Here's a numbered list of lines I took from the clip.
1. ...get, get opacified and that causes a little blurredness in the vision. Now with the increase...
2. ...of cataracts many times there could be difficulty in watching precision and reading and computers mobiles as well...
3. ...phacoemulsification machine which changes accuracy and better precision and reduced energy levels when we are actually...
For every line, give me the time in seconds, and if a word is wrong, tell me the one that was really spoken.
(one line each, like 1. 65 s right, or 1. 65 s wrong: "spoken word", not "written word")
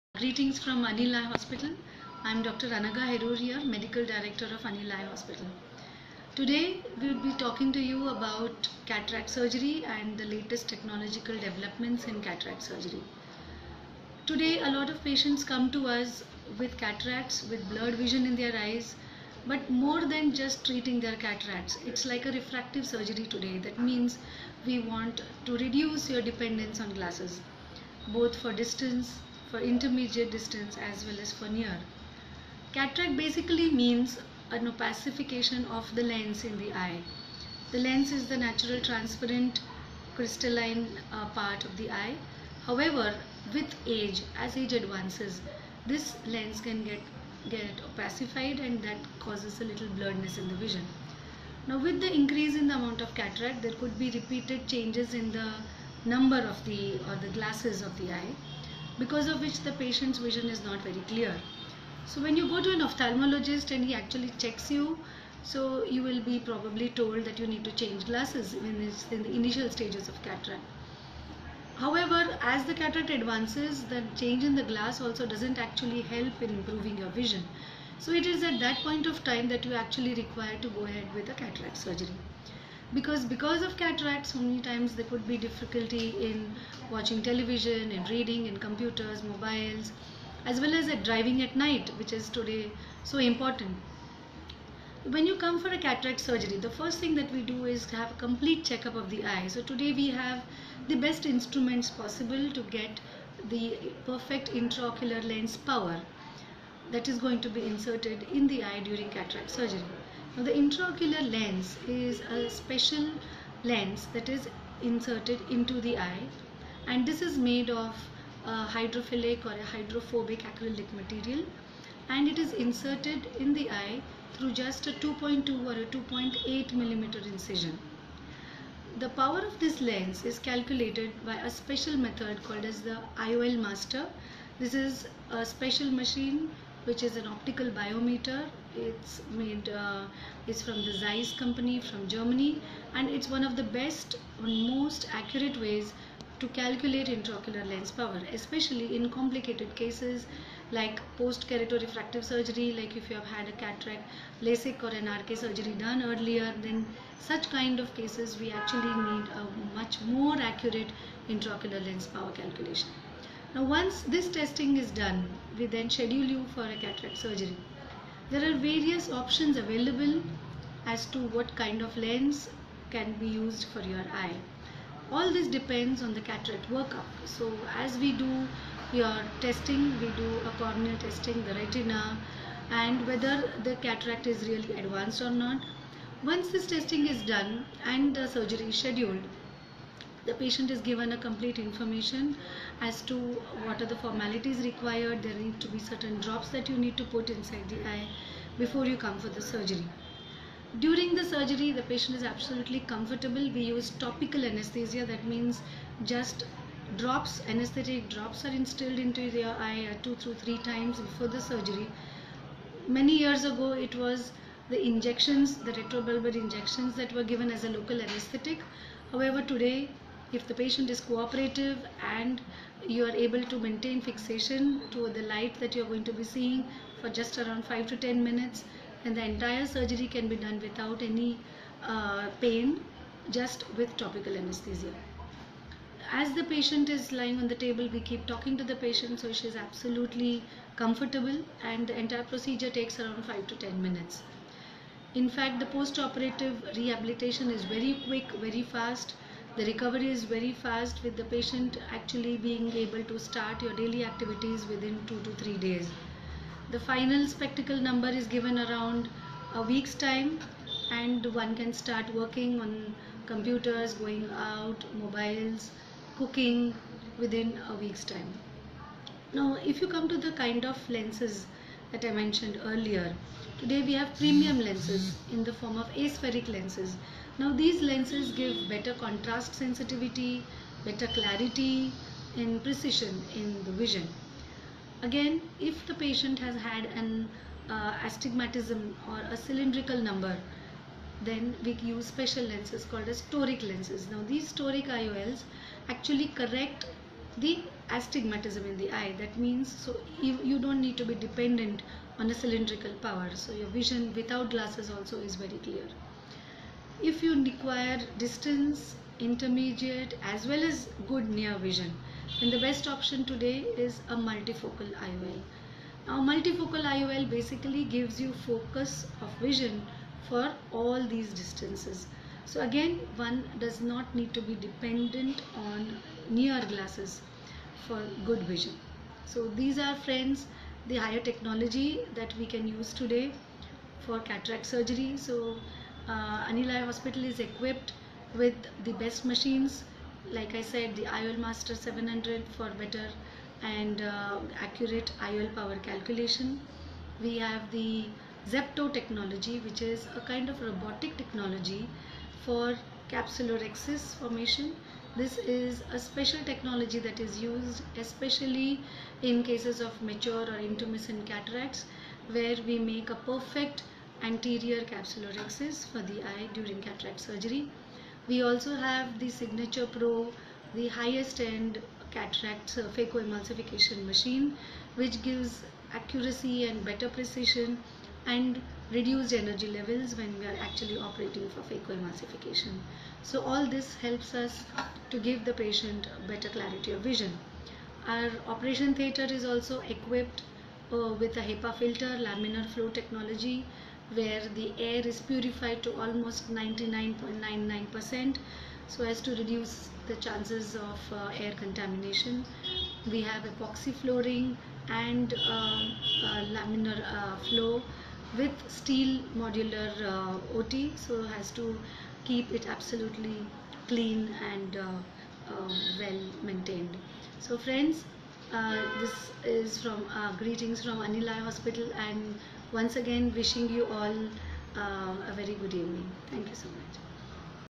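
1. 46 s right
2. 83 s wrong: "television", not "precision"
3. 372 s wrong: "gives", not "changes".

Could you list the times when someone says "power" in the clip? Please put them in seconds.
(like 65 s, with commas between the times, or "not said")
105 s, 129 s, 147 s, 162 s, 302 s, 345 s.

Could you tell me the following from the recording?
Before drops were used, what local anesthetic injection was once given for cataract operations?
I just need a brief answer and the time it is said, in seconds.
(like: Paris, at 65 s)
retrobulbar injections, at 215 s.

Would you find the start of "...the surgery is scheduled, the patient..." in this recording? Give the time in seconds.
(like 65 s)
188 s.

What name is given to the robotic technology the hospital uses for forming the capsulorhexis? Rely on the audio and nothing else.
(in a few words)
Zepto.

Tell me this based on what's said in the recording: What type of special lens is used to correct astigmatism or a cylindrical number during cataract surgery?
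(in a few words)
toric lenses.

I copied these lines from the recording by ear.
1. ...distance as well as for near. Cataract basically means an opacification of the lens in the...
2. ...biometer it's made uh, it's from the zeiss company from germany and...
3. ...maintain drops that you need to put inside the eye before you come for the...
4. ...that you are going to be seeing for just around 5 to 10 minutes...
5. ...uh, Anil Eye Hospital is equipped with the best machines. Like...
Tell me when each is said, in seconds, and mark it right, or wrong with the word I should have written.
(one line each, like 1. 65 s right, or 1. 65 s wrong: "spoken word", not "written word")
1. 30 s right
2. 137 s right
3. 195 s wrong: "certain", not "maintain"
4. 225 s right
5. 336 s right.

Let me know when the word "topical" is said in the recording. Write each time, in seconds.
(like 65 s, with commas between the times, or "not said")
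204 s, 233 s.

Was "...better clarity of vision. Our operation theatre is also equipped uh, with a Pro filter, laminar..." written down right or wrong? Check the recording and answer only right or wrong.
wrong.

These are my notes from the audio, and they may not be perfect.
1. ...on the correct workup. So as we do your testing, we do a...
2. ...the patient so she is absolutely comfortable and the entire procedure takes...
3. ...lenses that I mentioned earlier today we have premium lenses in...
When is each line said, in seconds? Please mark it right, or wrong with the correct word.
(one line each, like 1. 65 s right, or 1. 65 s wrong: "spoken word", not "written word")
1. 176 s wrong: "cataract", not "correct"
2. 238 s right
3. 270 s right.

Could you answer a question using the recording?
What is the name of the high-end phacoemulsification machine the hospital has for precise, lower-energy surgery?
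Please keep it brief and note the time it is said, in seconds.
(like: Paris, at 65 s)
Signature Pro, at 369 s.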